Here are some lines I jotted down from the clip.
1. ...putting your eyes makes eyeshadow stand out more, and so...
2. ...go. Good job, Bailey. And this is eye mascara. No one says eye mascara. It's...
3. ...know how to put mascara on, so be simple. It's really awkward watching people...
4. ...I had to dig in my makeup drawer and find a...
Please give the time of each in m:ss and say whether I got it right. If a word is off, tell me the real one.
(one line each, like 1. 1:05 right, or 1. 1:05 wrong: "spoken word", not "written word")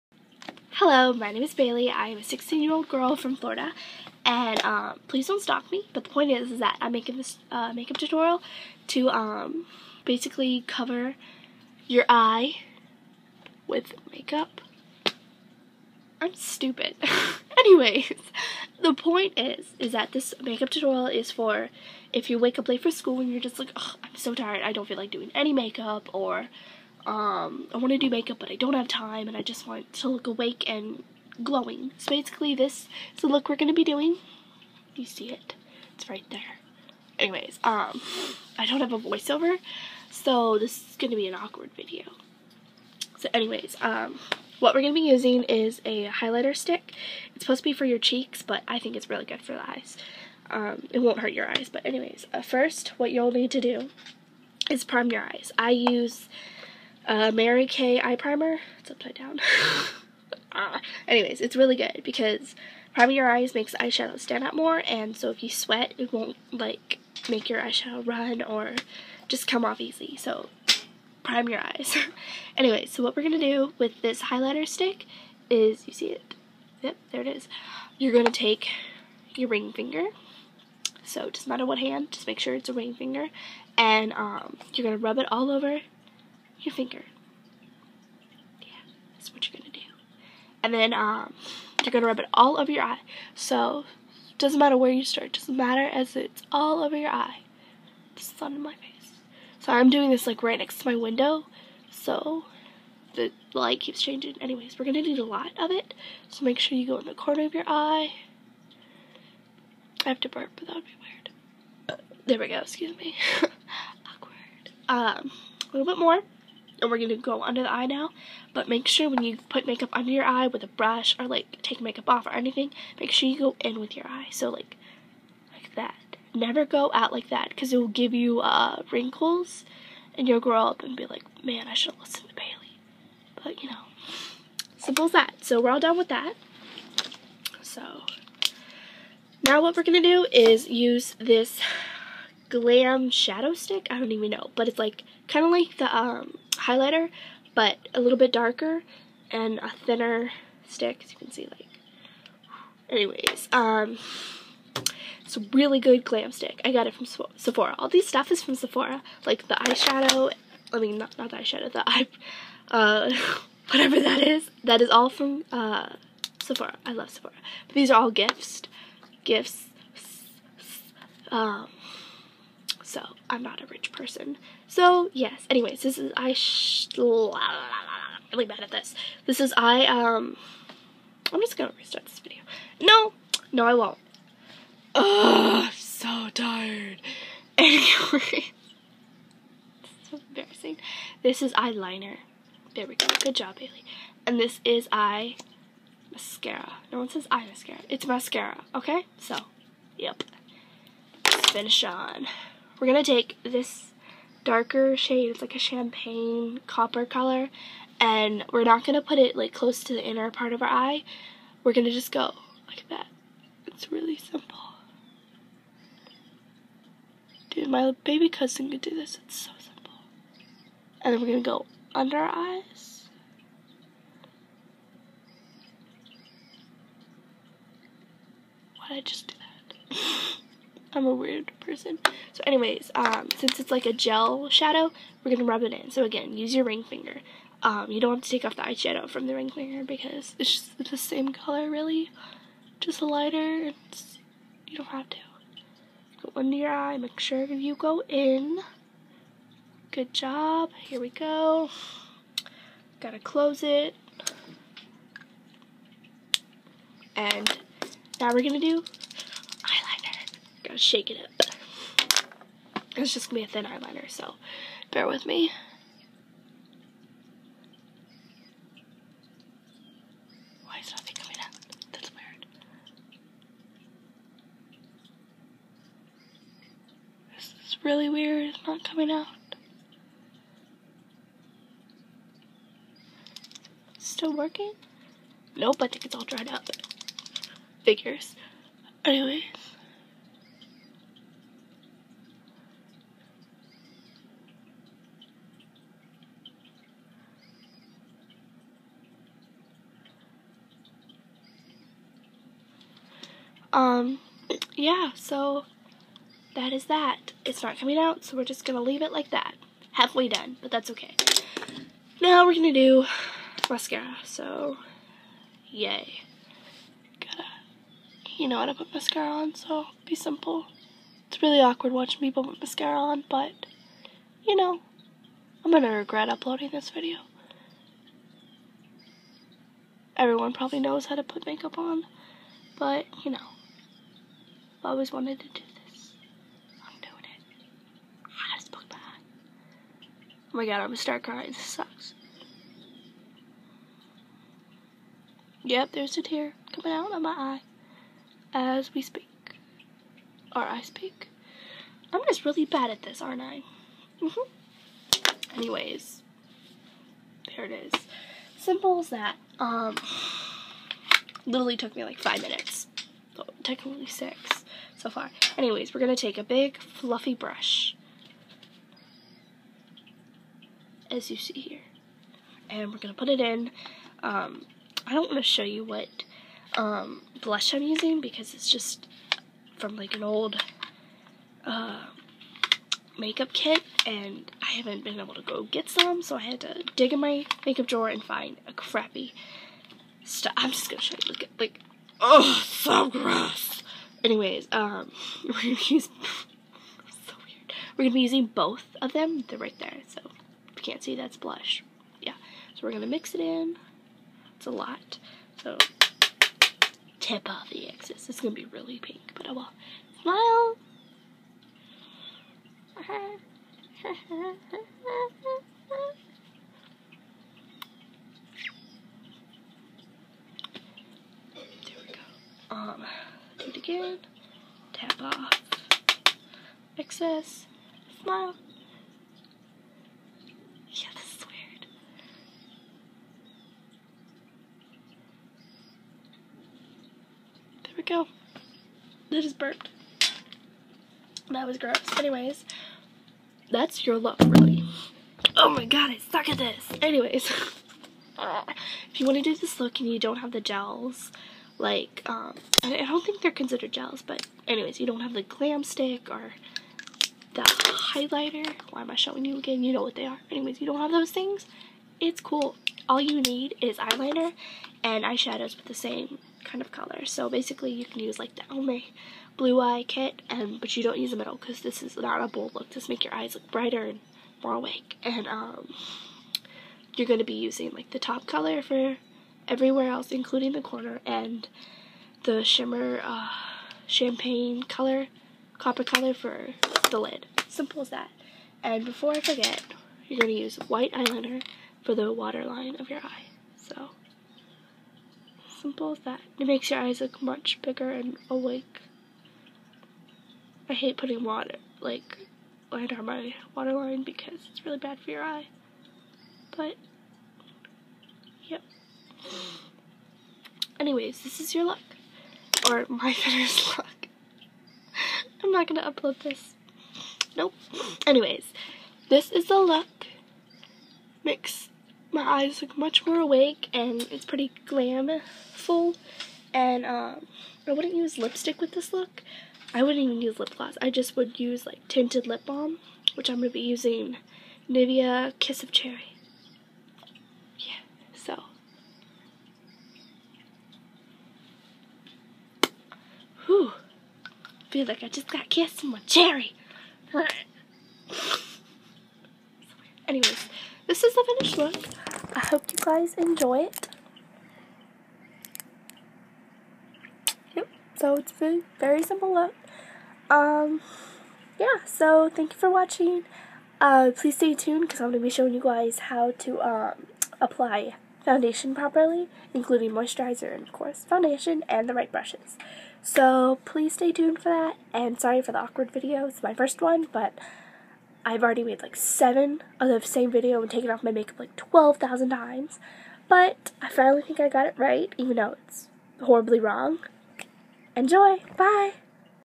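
1. 1:02 wrong: "priming", not "putting"
2. 3:12 right
3. 5:18 right
4. 6:26 right.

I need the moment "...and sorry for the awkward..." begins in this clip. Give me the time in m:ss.
9:35.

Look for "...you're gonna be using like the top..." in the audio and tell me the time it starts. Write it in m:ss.
7:57.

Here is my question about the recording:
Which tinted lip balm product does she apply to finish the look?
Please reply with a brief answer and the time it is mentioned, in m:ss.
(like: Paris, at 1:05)
Nivea Kiss of Cherry, at 8:54.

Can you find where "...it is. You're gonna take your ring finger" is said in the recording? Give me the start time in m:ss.
1:17.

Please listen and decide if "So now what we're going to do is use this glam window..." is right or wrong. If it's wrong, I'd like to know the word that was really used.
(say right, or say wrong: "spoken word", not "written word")
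wrong: "shadow", not "window".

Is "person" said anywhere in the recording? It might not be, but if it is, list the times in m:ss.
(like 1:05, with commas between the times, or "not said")
2:53, 3:51.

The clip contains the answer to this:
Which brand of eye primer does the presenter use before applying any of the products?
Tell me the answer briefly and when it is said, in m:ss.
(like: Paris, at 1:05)
Mary Kay, at 0:57.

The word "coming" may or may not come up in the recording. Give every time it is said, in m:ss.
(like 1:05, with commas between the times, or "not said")
4:31, 4:38, 5:07, 5:46.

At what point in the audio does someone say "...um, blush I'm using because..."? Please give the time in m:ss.
6:16.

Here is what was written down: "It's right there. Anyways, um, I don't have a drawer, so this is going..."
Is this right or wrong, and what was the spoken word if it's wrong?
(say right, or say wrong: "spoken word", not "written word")
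wrong: "voiceover", not "drawer".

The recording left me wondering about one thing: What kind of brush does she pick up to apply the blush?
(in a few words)
big fluffy brush.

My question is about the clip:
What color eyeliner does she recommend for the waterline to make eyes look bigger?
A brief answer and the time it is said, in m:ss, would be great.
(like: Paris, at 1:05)
white, at 8:10.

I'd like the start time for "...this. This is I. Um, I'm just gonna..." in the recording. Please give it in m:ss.
2:58.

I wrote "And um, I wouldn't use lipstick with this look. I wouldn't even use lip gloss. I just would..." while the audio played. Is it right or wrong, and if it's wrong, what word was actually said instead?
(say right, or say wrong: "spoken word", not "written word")
right.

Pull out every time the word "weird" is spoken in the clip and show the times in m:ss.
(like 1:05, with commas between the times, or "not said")
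1:50, 3:51, 4:32, 4:38, 6:37, 7:11.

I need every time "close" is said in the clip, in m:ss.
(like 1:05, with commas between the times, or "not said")
3:29, 4:13.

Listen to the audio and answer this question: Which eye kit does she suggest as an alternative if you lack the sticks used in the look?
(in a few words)
Almay Blue Eye Kit.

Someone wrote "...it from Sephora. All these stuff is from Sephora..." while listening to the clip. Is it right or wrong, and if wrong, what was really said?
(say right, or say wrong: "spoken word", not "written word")
right.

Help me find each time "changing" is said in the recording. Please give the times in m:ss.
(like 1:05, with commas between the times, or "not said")
1:44.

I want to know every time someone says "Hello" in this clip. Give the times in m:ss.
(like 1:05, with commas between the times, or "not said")
0:00.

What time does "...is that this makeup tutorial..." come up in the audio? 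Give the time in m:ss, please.
0:19.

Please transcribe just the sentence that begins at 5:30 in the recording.
Everyone probably knows how to put makeup on, but, you know.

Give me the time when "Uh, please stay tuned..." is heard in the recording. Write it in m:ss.
9:24.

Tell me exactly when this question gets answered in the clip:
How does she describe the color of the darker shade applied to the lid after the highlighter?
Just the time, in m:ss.
3:25.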